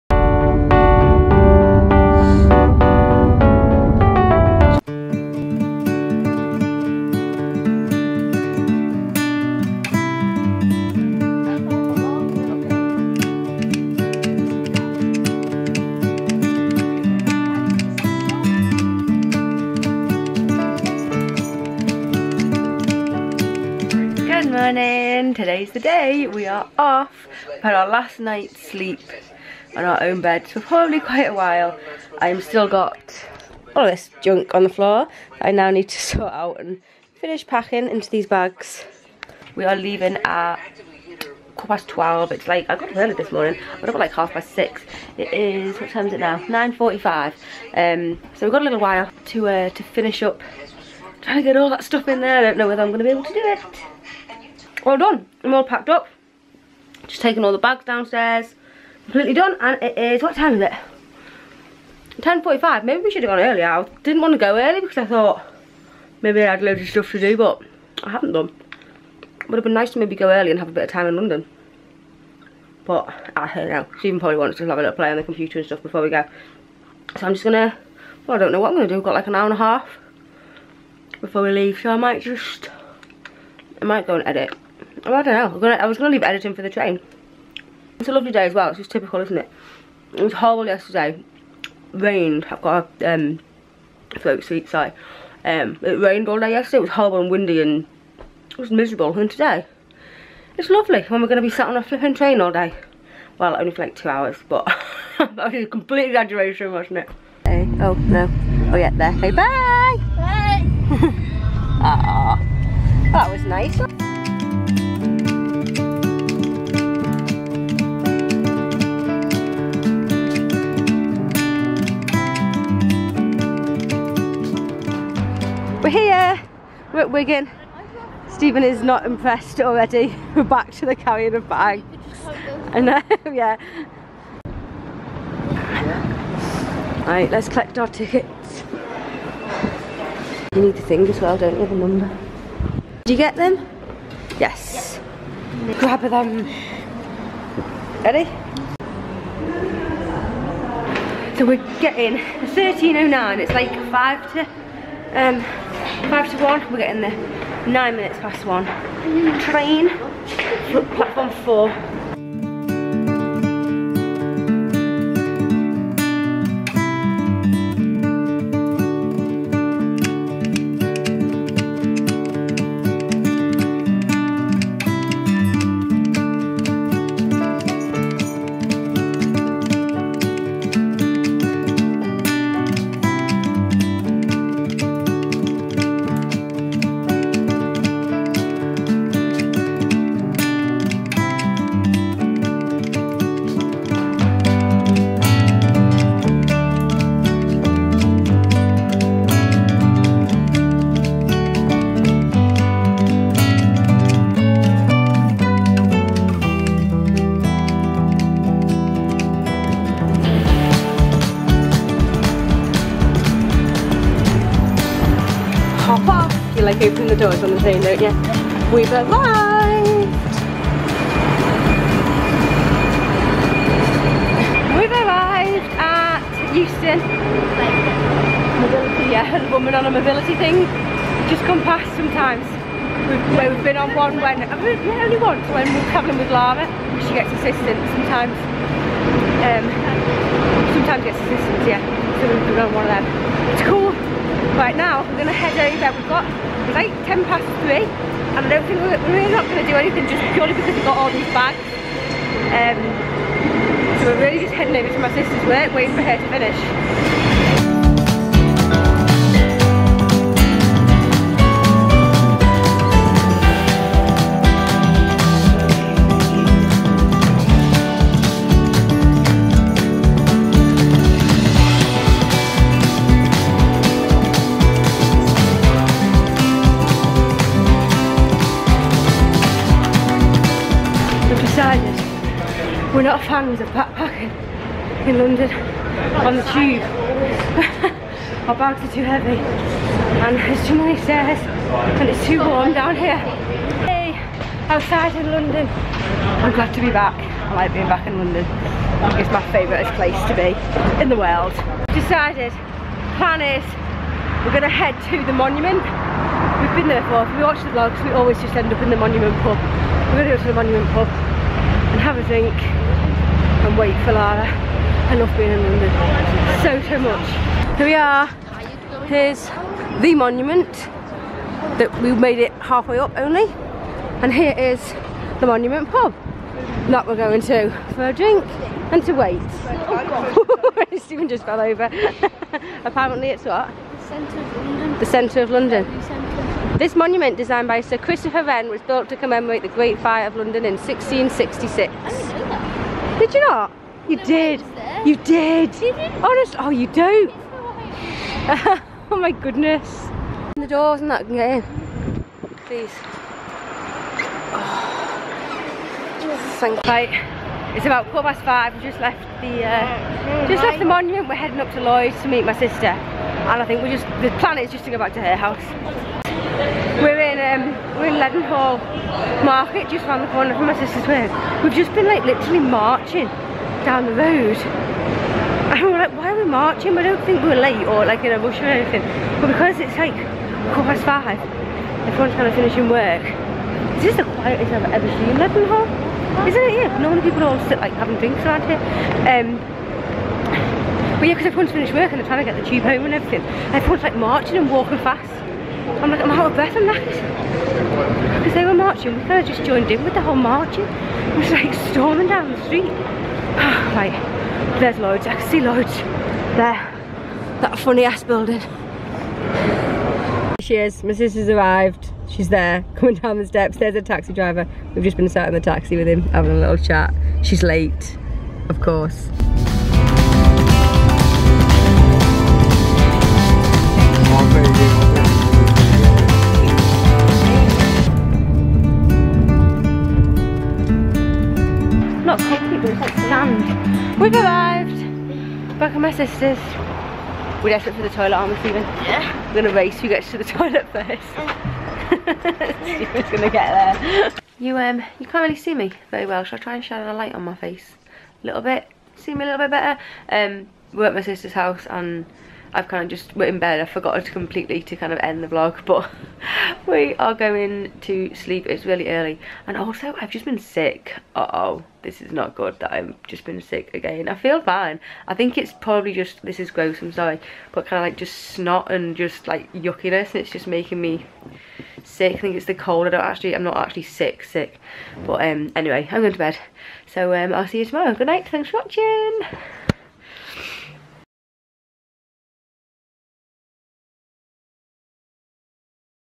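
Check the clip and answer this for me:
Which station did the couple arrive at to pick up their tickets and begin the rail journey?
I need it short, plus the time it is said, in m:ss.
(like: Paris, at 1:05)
Wigan, at 2:07.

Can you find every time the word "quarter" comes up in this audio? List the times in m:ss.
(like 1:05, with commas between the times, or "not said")
0:41, 5:58, 6:20.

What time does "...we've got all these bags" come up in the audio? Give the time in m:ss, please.
4:10.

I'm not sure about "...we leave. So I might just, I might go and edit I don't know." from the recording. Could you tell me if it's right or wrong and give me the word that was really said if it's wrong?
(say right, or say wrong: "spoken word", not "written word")
right.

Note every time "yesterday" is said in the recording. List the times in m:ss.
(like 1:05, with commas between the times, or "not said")
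1:30, 1:36.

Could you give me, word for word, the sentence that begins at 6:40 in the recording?
It was like storming down the street.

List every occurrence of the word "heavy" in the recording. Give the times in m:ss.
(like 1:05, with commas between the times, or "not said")
4:49.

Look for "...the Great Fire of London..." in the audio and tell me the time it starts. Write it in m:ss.
5:39.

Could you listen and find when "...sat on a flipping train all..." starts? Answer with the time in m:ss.
1:41.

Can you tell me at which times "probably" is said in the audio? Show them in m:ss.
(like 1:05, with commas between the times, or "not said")
0:30, 1:14, 7:45.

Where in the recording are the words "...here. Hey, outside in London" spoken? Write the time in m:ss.
4:52.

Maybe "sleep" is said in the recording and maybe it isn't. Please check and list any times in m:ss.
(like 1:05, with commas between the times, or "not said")
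0:28, 7:38.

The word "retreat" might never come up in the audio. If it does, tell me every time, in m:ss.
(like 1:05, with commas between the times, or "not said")
not said.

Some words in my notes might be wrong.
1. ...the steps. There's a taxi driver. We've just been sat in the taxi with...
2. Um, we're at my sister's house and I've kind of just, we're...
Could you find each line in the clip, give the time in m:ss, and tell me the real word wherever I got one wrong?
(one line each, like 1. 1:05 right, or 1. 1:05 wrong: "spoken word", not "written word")
1. 6:53 right
2. 7:30 right.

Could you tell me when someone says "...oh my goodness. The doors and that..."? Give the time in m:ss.
5:47.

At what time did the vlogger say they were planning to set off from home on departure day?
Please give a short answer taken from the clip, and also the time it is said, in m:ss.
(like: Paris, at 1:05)
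12:15, at 0:41.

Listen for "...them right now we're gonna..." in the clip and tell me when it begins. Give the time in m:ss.
4:03.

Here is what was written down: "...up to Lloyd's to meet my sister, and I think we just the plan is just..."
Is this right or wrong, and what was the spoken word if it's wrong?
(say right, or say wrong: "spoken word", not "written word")
right.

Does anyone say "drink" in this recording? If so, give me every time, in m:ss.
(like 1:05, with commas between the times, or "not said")
5:12, 5:28, 6:28.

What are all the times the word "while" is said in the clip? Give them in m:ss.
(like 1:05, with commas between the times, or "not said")
0:31, 0:48.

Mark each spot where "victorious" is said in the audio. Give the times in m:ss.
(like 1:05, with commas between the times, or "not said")
not said.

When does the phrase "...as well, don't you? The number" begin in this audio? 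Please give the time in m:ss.
2:21.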